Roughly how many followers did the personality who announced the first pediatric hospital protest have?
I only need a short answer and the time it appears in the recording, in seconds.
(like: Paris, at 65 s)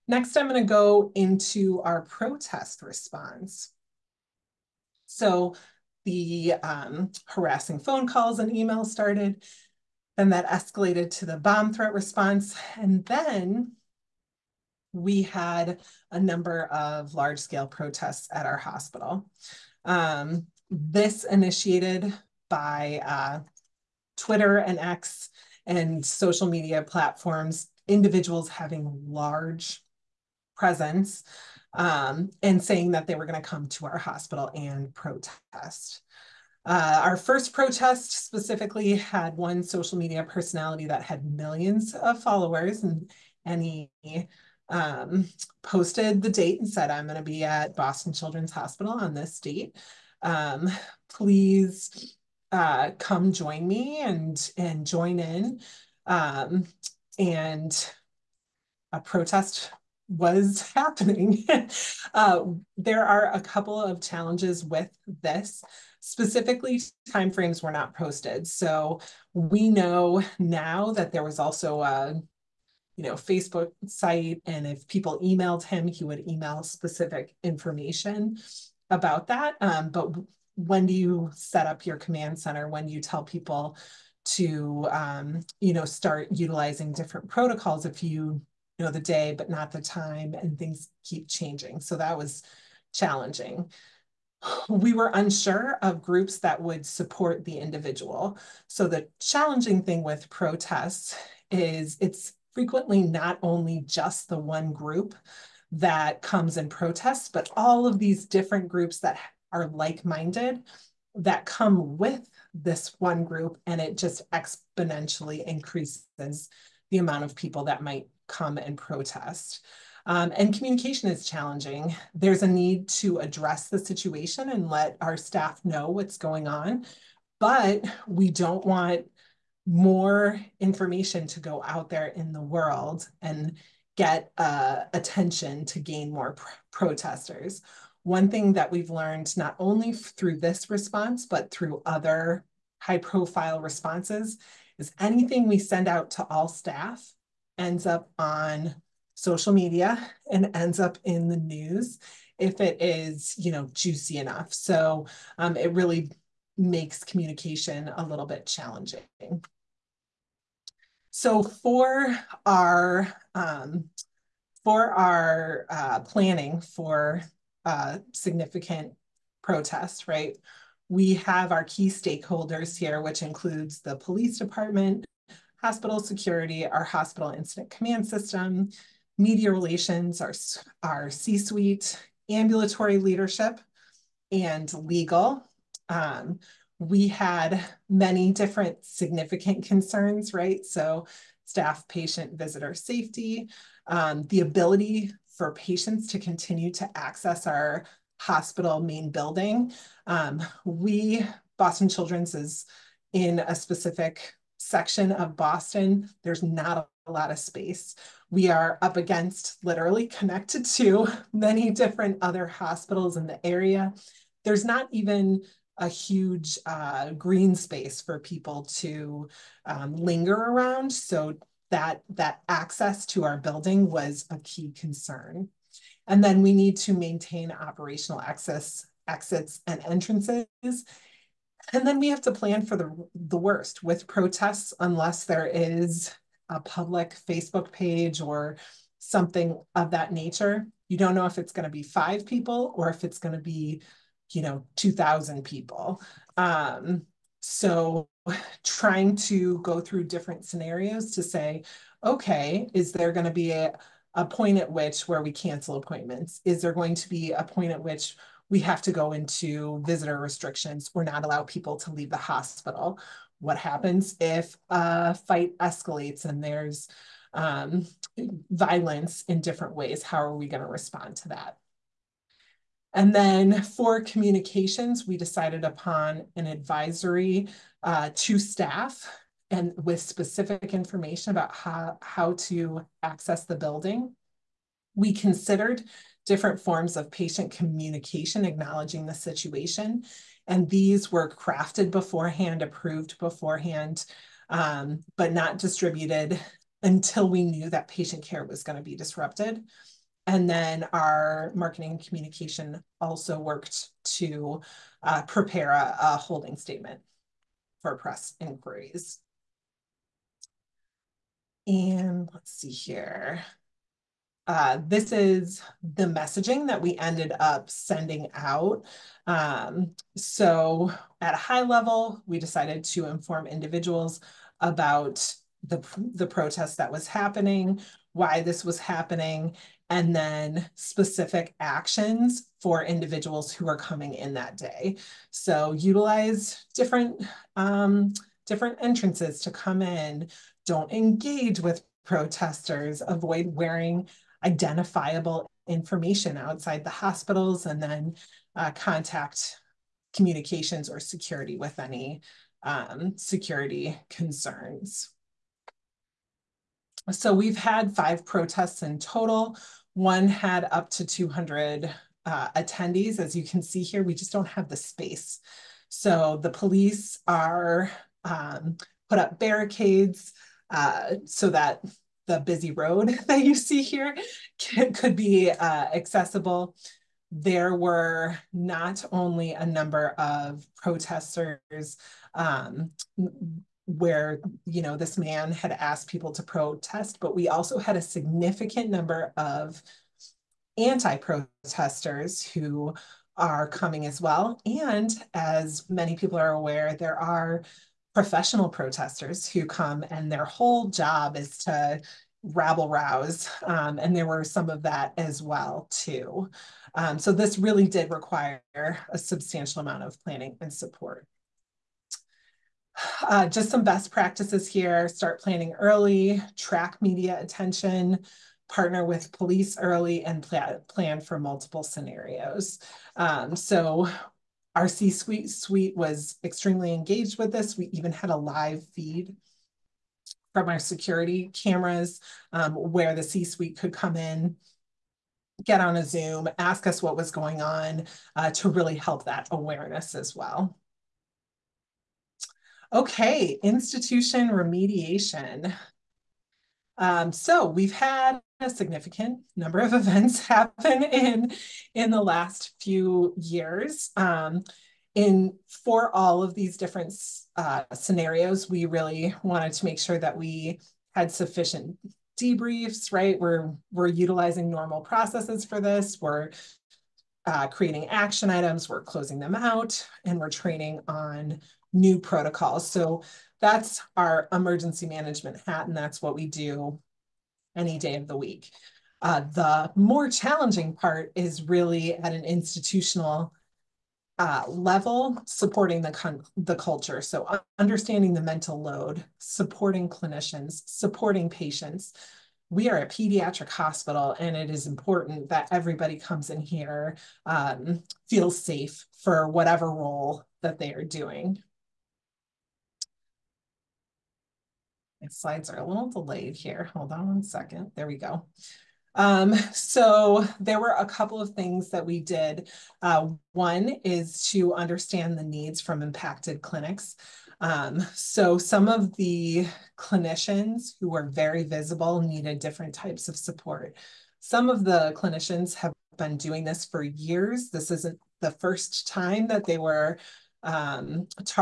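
millions, at 41 s.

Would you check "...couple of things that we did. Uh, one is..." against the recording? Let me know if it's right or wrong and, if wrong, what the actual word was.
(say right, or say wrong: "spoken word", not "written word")
right.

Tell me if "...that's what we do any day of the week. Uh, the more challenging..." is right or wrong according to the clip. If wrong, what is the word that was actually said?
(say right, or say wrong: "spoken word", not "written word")
right.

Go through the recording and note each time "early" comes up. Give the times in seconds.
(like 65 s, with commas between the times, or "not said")
415 s, 419 s.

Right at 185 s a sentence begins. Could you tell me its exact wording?
Um, we had many different significant concerns, right?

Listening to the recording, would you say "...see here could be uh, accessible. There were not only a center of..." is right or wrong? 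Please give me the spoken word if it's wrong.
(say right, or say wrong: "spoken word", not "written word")
wrong: "number", not "center".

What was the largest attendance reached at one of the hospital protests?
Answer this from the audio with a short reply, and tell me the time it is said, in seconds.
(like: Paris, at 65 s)
200, at 360 s.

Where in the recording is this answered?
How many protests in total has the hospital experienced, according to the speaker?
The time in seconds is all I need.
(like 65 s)
357 s.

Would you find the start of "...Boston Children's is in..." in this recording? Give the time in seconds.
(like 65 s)
201 s.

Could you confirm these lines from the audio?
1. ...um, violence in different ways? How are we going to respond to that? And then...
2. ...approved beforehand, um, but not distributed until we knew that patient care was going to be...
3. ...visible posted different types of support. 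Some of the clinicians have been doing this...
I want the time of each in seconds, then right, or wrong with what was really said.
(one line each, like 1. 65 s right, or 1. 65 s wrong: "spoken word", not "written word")
1. 267 s right
2. 292 s right
3. 521 s wrong: "needed", not "posted".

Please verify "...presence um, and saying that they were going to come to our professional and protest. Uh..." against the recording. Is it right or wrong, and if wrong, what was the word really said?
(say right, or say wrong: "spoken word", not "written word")
wrong: "hospital", not "professional".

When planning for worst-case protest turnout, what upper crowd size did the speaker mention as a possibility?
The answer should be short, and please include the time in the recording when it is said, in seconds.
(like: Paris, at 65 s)
2,000, at 244 s.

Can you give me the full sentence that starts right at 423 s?
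Um, so our C suite suite was extremely engaged with this.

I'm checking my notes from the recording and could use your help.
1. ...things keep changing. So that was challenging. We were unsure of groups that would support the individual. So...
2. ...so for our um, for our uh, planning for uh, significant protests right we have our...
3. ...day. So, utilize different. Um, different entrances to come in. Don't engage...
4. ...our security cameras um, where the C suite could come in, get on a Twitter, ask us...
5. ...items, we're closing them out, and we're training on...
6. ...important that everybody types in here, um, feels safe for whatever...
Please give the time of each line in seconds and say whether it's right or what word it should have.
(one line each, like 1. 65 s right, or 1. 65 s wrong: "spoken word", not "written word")
1. 90 s right
2. 161 s right
3. 334 s right
4. 430 s wrong: "Zoom", not "Twitter"
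5. 468 s right
6. 494 s wrong: "comes", not "types".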